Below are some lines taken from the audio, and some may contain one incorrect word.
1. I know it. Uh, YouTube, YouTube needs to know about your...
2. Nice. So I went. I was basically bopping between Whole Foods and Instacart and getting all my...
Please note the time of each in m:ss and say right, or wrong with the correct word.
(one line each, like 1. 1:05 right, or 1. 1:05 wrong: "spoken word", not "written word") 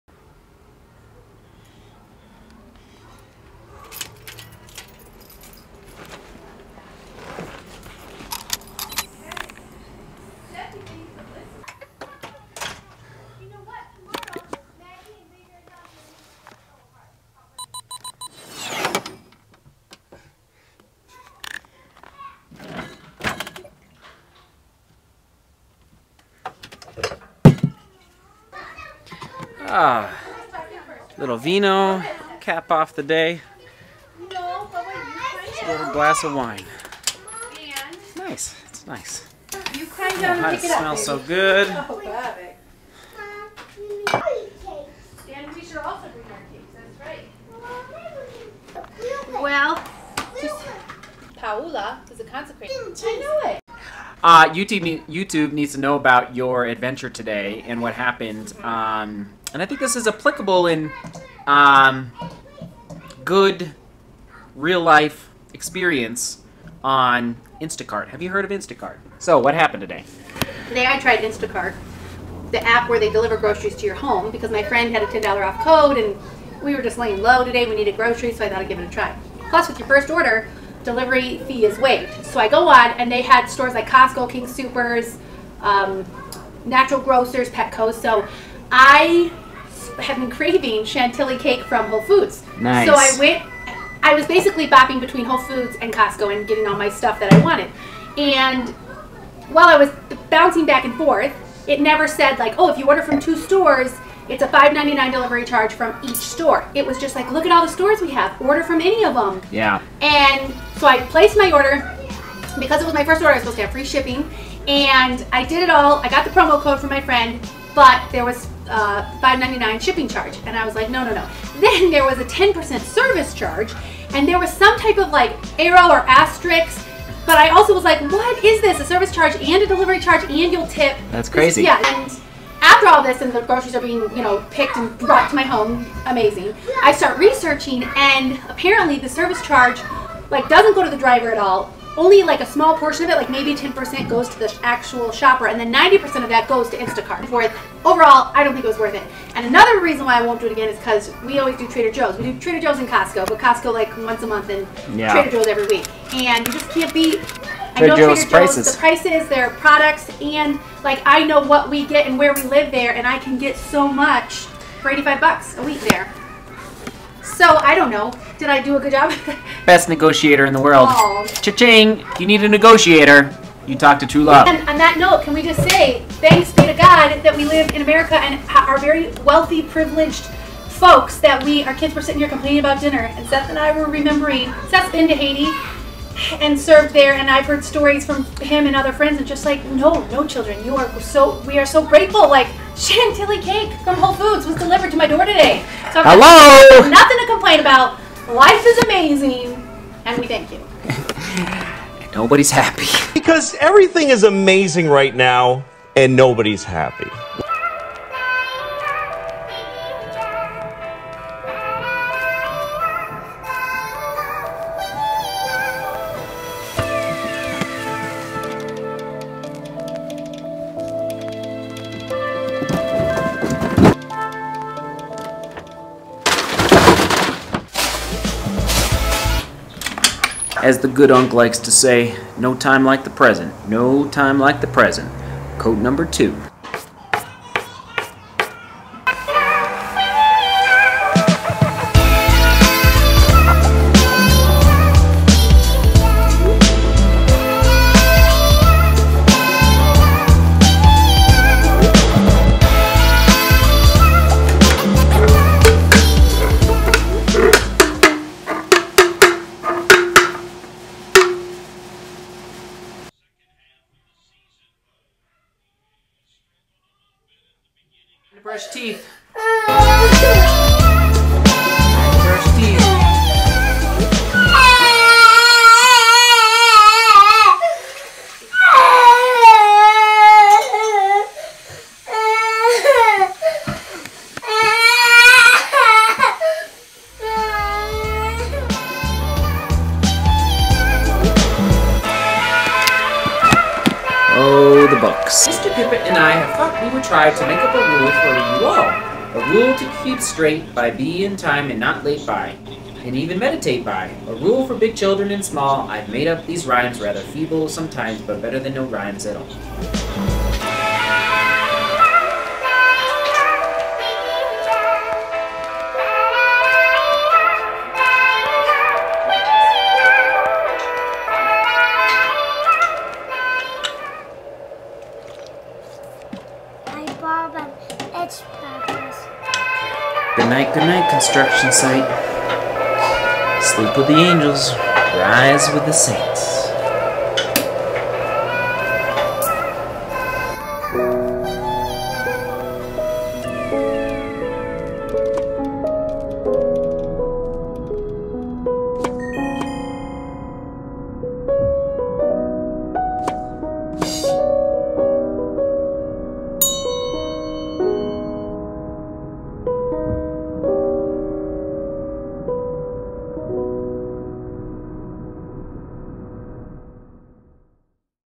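1. 0:53 right
2. 1:32 wrong: "Costco", not "Instacart".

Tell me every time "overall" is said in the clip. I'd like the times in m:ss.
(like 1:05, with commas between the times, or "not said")
2:27.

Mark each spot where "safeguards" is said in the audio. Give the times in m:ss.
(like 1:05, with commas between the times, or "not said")
not said.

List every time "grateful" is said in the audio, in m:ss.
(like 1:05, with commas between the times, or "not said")
3:11.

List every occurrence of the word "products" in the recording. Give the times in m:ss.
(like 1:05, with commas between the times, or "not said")
2:39.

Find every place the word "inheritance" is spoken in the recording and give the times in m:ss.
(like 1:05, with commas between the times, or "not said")
not said.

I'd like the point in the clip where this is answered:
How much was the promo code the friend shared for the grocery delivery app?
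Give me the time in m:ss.
1:15.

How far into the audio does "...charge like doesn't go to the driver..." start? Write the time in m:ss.
2:19.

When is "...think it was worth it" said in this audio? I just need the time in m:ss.
2:28.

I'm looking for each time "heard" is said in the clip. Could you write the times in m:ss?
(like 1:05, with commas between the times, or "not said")
1:08, 3:07.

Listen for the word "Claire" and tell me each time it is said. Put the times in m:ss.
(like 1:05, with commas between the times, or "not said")
not said.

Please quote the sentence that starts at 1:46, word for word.
It was just like, look at all the stores we have.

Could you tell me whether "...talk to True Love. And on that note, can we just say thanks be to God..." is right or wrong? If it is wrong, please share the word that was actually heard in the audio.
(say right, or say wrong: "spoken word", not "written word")
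right.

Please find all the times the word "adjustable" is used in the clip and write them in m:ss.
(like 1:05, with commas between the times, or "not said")
not said.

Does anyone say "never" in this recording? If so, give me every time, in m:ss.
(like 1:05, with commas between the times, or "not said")
1:41.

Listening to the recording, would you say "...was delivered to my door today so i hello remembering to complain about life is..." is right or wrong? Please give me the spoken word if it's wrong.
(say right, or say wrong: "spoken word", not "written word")
wrong: "nothing", not "remembering".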